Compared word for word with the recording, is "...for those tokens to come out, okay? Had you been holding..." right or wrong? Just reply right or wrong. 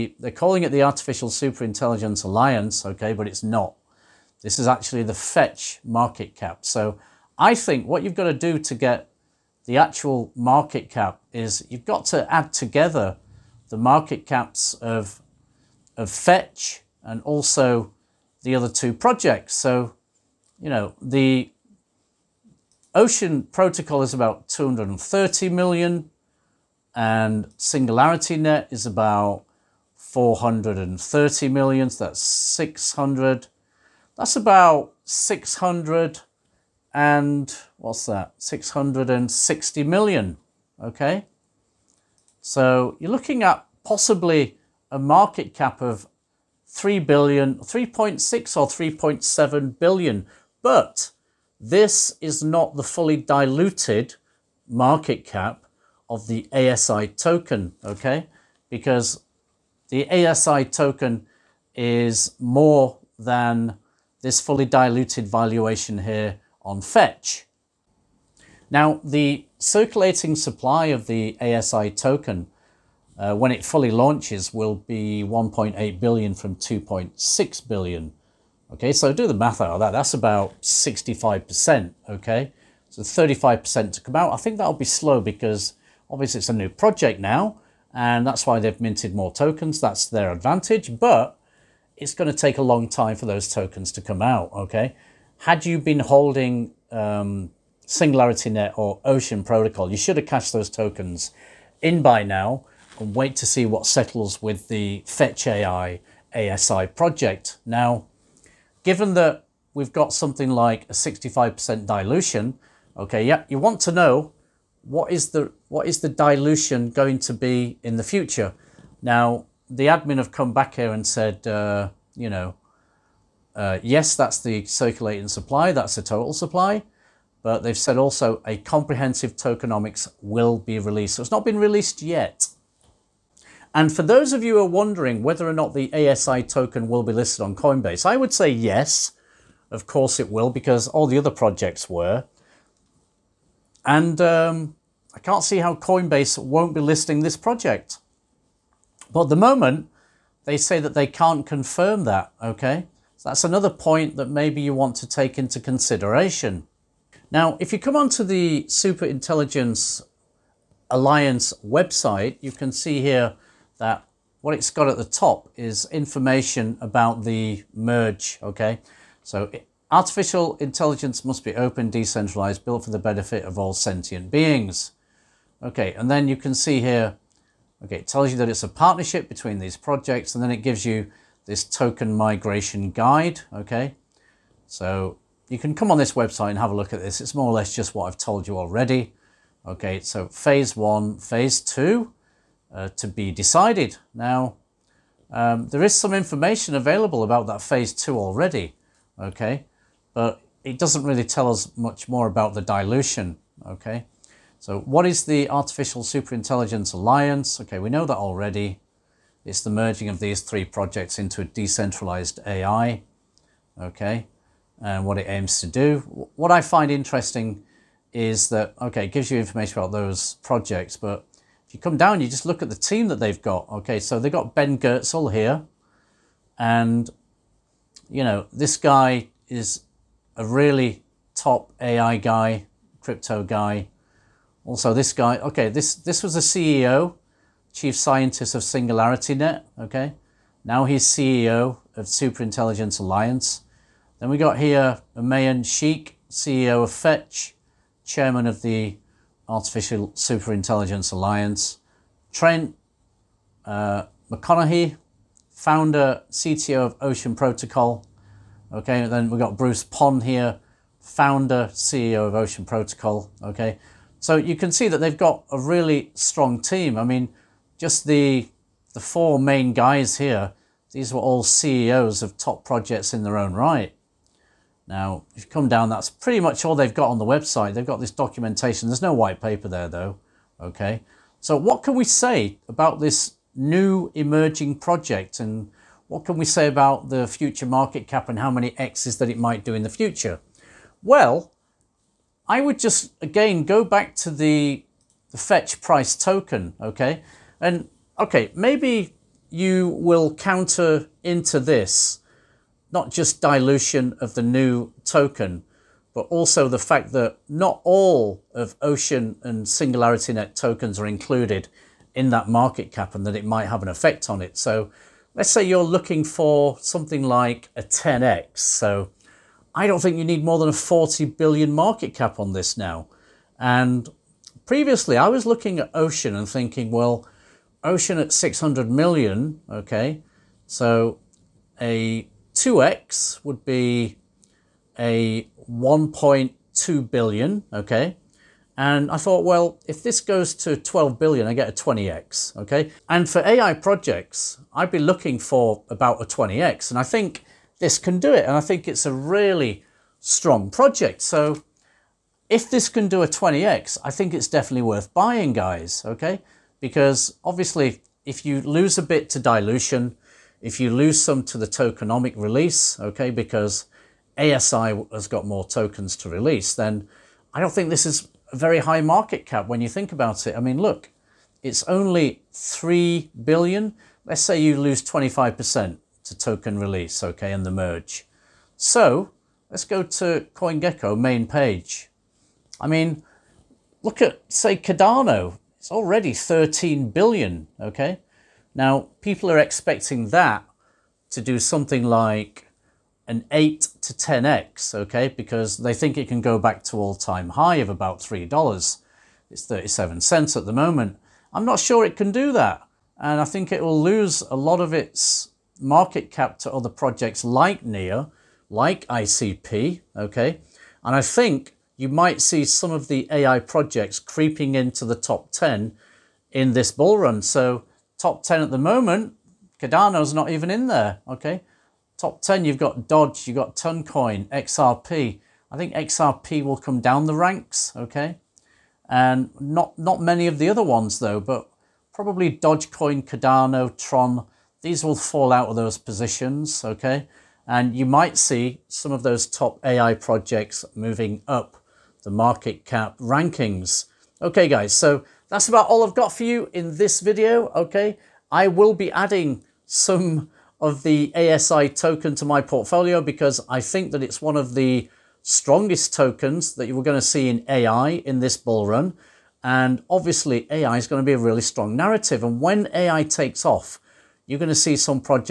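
right.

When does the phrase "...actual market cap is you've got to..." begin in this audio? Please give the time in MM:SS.
00:09.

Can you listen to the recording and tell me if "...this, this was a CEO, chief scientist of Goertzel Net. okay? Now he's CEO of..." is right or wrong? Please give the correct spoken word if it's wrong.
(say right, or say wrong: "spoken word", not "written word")
wrong: "Singularity", not "Goertzel".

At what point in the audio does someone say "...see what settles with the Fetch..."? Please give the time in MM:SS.
01:43.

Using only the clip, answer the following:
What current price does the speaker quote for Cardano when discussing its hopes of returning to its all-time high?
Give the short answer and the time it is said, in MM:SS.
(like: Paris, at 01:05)
37 cents, at 06:39.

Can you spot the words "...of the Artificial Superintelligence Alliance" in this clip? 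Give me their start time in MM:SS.
04:08.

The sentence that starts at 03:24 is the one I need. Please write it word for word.
So what is the Artificial Superintelligence Alliance?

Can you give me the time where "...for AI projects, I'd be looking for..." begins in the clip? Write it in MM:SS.
05:43.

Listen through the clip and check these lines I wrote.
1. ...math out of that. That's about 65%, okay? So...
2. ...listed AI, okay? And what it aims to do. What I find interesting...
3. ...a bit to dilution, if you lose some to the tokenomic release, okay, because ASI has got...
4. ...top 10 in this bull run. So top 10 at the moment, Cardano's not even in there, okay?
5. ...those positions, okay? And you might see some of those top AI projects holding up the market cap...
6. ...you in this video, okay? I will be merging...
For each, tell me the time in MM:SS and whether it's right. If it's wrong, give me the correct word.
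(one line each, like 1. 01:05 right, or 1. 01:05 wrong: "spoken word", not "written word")
1. 01:19 right
2. 03:31 wrong: "decentralized", not "listed"
3. 05:58 right
4. 06:55 right
5. 07:15 wrong: "moving", not "holding"
6. 07:26 wrong: "adding", not "merging".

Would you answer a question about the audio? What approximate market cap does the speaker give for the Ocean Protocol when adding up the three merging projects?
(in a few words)
230 million.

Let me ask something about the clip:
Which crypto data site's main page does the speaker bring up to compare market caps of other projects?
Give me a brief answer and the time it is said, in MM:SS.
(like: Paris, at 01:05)
CoinGecko, at 06:20.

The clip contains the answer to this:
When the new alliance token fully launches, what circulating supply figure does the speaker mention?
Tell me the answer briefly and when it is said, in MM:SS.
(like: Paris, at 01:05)
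1.8 billion, at 01:15.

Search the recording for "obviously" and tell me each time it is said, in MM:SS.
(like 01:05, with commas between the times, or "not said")
01:26, 05:57, 07:40.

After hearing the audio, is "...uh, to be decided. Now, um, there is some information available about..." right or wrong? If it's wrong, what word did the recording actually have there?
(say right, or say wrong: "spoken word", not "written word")
right.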